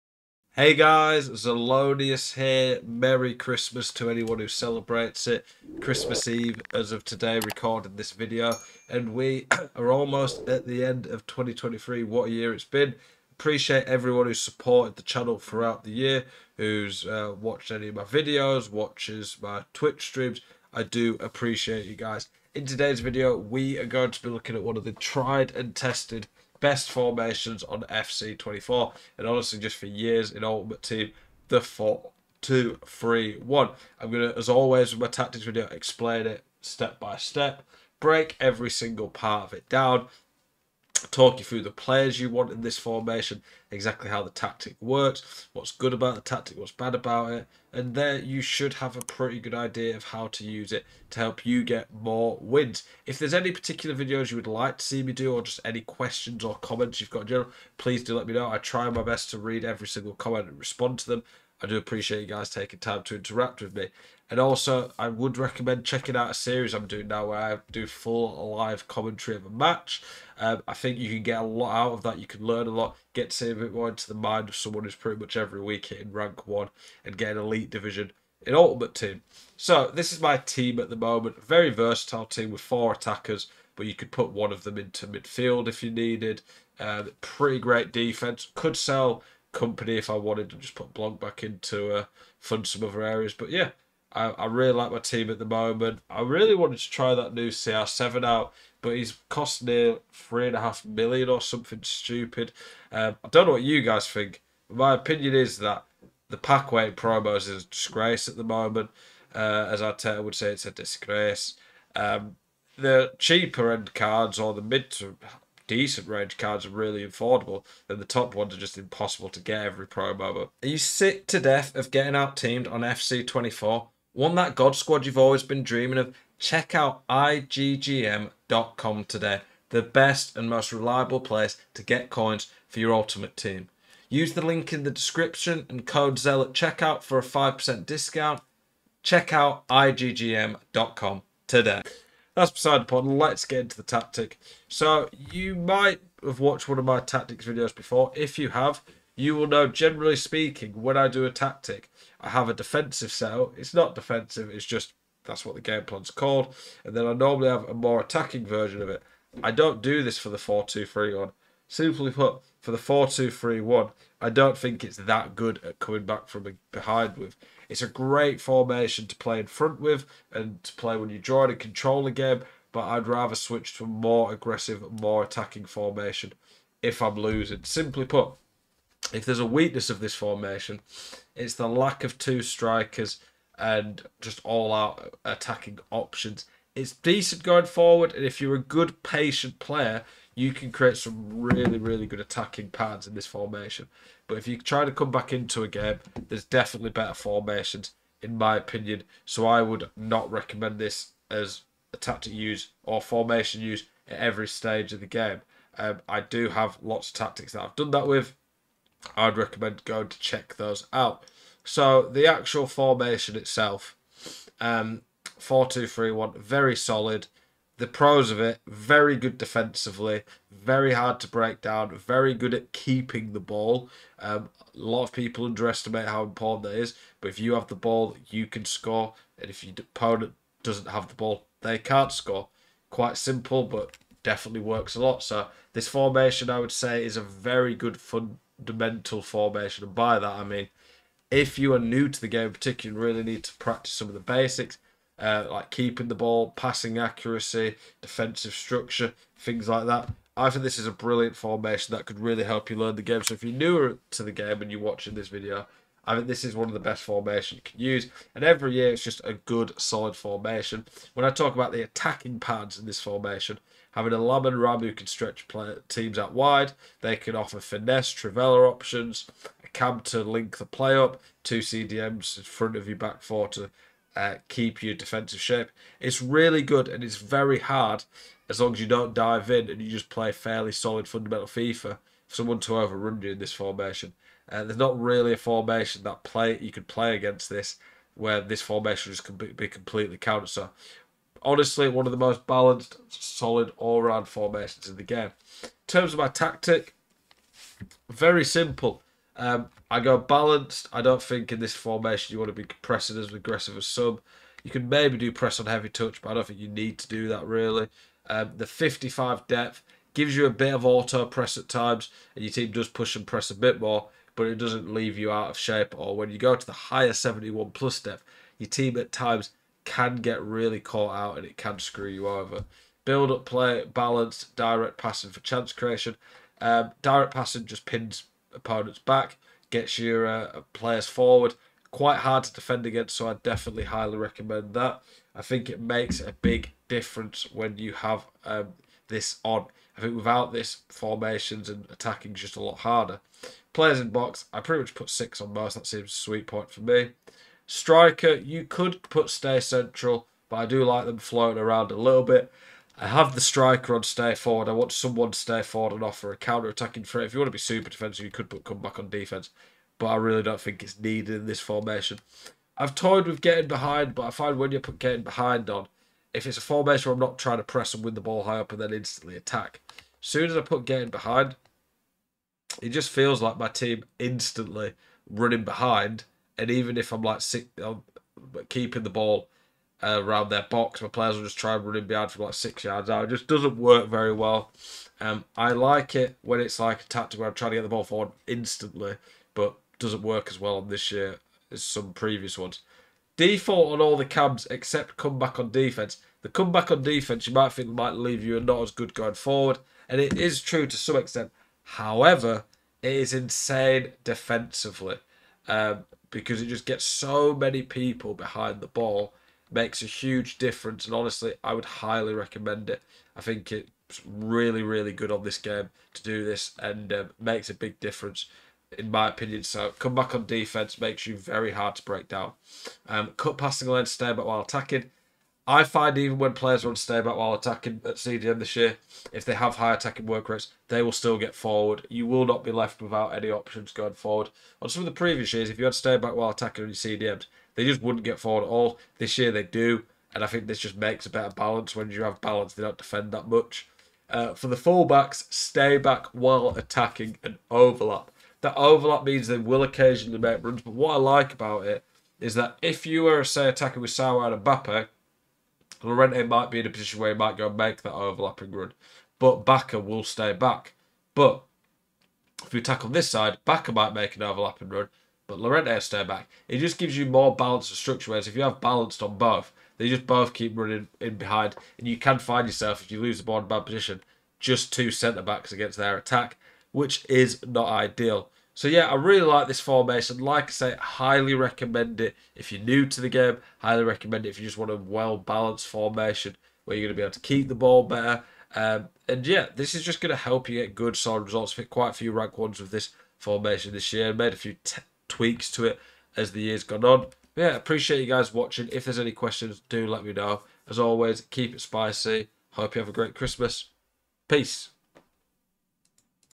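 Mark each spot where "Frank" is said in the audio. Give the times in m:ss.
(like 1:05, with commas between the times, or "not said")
not said.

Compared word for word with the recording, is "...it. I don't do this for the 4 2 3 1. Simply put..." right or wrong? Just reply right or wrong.
right.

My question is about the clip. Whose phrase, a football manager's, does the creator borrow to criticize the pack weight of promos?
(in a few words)
Arteta.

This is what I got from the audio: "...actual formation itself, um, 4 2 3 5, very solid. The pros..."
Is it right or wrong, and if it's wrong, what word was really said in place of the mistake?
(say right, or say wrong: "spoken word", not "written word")
wrong: "1", not "5".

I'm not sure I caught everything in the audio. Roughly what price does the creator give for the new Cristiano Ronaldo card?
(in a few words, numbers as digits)
3.5 million.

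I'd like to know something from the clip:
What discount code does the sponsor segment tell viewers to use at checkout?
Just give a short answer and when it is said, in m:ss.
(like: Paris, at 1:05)
ZEL, at 2:16.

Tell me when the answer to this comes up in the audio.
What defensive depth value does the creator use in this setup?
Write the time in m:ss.
5:08.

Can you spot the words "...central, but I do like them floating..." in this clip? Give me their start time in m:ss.
5:49.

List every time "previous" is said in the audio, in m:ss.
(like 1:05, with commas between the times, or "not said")
6:32, 7:15.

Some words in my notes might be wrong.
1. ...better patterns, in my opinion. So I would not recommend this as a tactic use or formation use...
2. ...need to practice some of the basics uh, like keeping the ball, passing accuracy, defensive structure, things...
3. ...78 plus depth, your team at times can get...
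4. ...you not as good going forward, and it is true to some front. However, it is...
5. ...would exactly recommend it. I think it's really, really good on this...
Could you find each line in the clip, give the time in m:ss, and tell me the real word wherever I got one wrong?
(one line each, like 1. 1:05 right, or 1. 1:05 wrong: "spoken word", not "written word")
1. 3:16 wrong: "formations", not "patterns"
2. 4:03 right
3. 5:17 wrong: "71", not "78"
4. 6:38 wrong: "extent", not "front"
5. 6:51 wrong: "highly", not "exactly".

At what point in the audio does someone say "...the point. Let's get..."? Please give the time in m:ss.
2:22.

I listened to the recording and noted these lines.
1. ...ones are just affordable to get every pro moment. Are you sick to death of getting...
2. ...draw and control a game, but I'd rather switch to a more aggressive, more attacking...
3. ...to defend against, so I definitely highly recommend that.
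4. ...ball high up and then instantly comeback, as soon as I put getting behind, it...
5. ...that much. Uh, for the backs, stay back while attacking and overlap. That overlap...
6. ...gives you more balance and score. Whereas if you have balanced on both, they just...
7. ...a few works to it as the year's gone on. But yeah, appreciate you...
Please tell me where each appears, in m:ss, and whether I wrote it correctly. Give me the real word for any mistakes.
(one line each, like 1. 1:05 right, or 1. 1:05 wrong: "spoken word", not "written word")
1. 1:58 wrong: "impossible", not "affordable"
2. 2:51 right
3. 5:32 right
4. 6:08 wrong: "attack", not "comeback"
5. 7:23 wrong: "fullbacks", not "backs"
6. 7:46 wrong: "structure", not "score"
7. 8:14 wrong: "tweaks", not "works".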